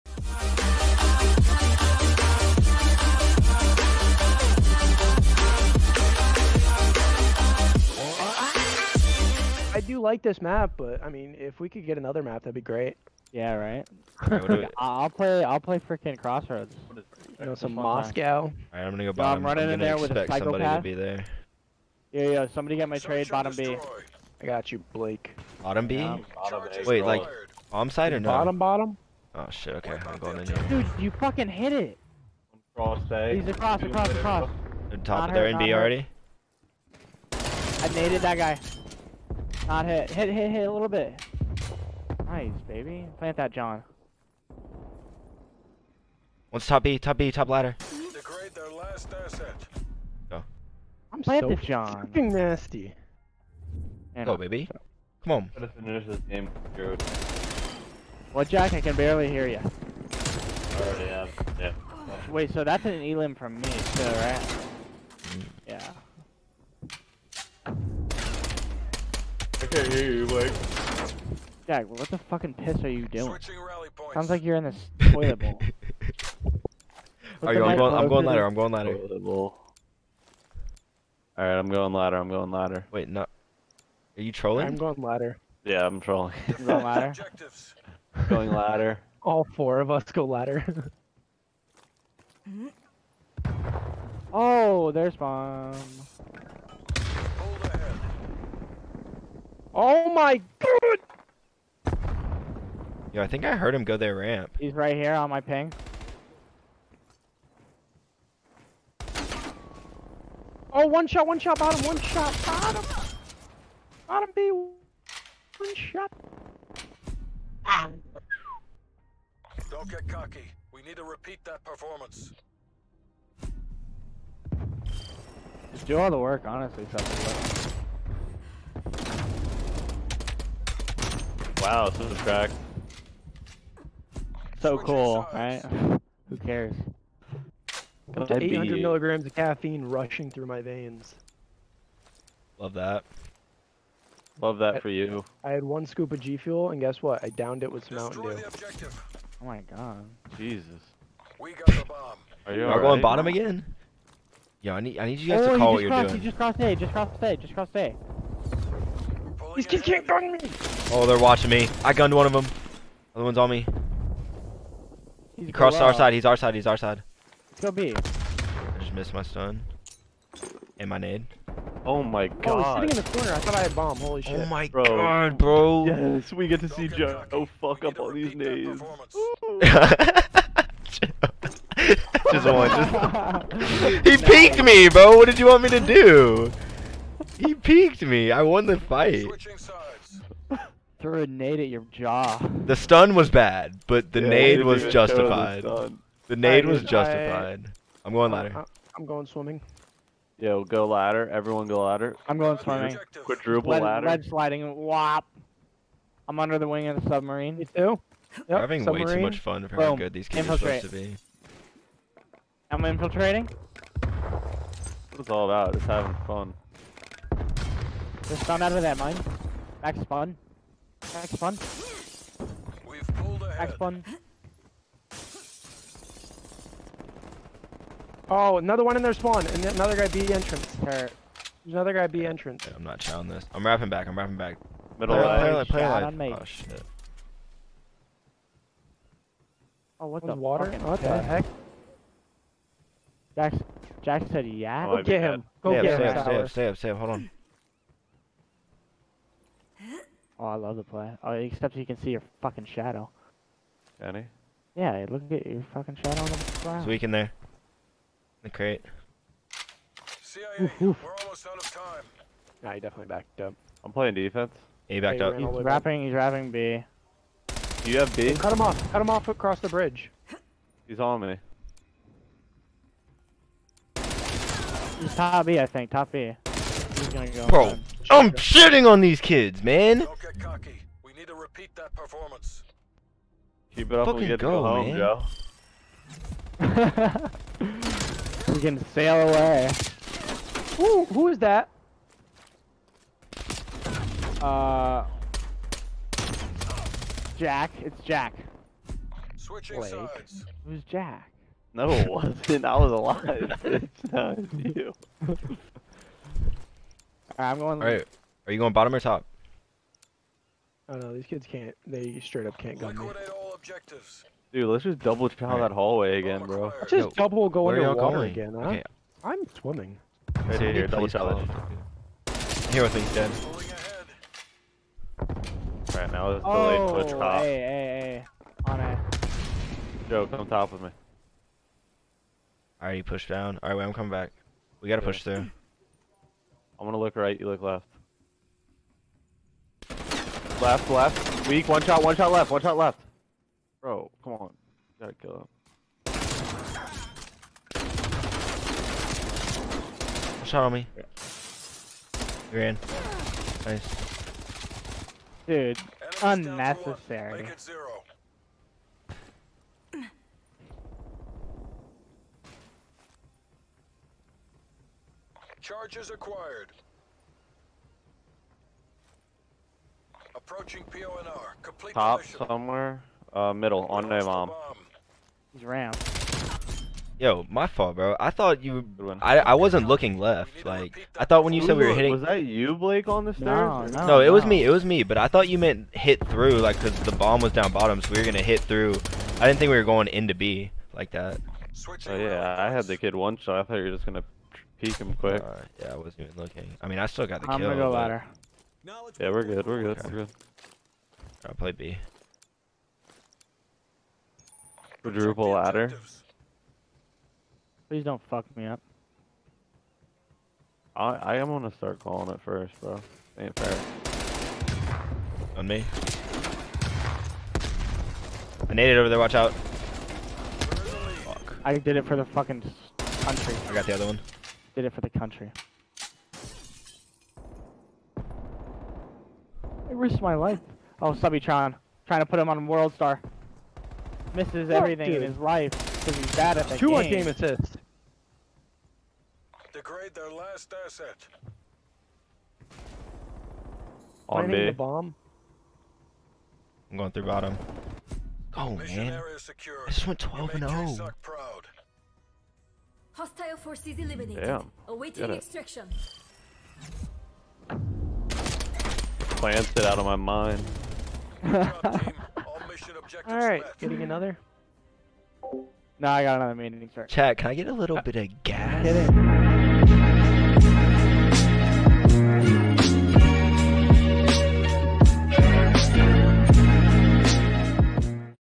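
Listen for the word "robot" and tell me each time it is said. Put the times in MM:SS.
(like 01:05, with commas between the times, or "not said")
not said.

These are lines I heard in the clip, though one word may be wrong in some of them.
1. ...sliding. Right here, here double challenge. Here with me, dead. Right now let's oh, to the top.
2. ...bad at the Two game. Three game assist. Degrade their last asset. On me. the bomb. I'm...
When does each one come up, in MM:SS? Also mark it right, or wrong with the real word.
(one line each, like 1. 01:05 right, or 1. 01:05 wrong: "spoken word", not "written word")
1. 05:19 wrong: "swimming", not "sliding"
2. 07:16 wrong: "Two", not "Three".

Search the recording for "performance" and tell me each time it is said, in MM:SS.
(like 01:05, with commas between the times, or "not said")
02:01, 04:41.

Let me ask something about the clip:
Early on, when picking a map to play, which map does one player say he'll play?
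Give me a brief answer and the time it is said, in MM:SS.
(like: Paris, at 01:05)
Crossroads, at 00:16.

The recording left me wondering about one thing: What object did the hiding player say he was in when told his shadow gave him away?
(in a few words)
The crate.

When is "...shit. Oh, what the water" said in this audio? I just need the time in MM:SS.
03:56.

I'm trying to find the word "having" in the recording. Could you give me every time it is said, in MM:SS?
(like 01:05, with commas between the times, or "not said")
03:28, 03:35.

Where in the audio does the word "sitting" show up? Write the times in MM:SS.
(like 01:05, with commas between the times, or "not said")
02:52.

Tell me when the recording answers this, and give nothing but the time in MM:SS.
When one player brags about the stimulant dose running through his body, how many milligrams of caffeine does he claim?
02:18.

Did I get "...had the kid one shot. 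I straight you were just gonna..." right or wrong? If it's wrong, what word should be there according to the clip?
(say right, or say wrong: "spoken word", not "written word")
wrong: "thought", not "straight".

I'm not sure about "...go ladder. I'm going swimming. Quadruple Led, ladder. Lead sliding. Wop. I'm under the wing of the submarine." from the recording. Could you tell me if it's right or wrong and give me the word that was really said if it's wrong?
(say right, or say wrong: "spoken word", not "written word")
right.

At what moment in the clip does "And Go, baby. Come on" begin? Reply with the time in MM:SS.
00:54.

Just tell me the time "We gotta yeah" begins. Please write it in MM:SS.
05:34.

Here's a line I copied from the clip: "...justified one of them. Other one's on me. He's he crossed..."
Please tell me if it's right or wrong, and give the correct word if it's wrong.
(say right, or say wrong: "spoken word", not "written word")
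wrong: "gunned", not "justified".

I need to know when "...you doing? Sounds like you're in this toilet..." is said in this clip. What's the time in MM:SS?
01:12.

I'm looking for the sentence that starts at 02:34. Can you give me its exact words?
Yo, I need, I need you guys oh, to call you what you're crossed, doing.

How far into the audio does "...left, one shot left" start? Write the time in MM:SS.
05:42.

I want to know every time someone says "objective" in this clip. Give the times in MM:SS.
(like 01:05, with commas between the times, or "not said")
02:28.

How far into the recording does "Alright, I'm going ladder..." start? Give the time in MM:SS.
01:18.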